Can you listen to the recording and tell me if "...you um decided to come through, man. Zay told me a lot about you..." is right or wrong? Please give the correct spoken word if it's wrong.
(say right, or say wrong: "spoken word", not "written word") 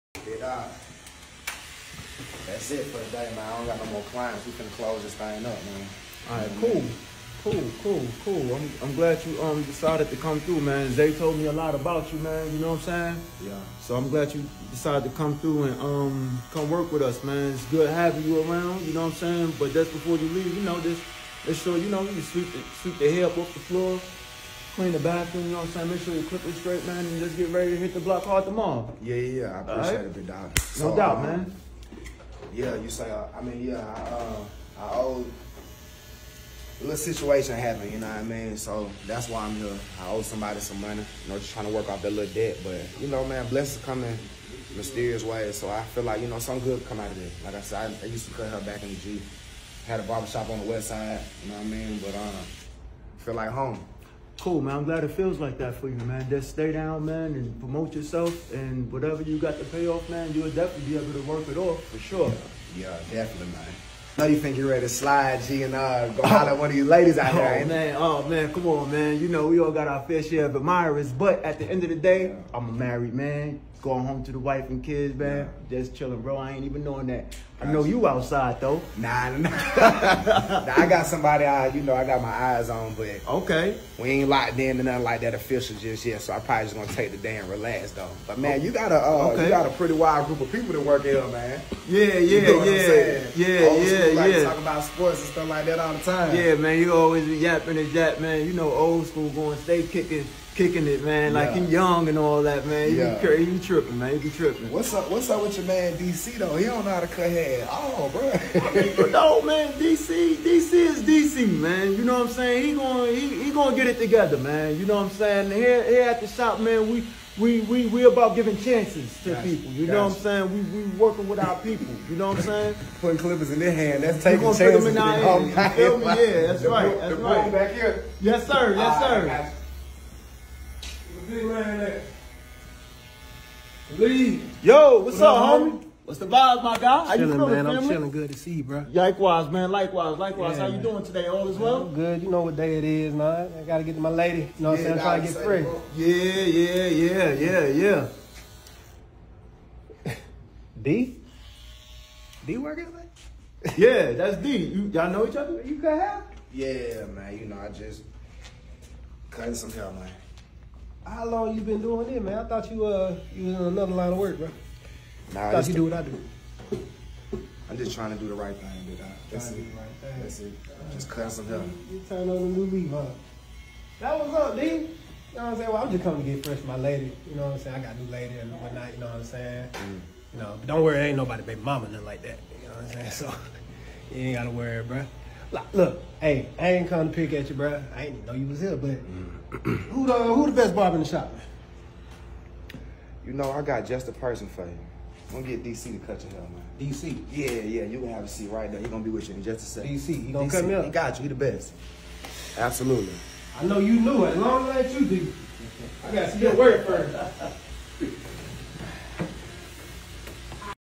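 right.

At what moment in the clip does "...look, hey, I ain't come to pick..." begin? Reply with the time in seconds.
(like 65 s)
185 s.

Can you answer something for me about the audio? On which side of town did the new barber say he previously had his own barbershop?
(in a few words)
West side.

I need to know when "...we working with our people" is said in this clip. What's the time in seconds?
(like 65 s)
120 s.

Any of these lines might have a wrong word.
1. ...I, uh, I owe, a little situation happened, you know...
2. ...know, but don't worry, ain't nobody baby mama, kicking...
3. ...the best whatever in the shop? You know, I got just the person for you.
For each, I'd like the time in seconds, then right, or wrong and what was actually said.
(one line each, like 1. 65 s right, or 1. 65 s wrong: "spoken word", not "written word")
1. 33 s right
2. 180 s wrong: "nothing", not "kicking"
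3. 190 s wrong: "barber", not "whatever".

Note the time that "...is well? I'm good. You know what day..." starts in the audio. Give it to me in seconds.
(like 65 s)
141 s.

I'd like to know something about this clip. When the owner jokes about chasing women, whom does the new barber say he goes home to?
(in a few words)
The wife and kids.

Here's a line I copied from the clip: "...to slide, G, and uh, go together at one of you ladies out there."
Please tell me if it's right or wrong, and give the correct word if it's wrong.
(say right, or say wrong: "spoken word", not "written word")
wrong: "holler", not "together".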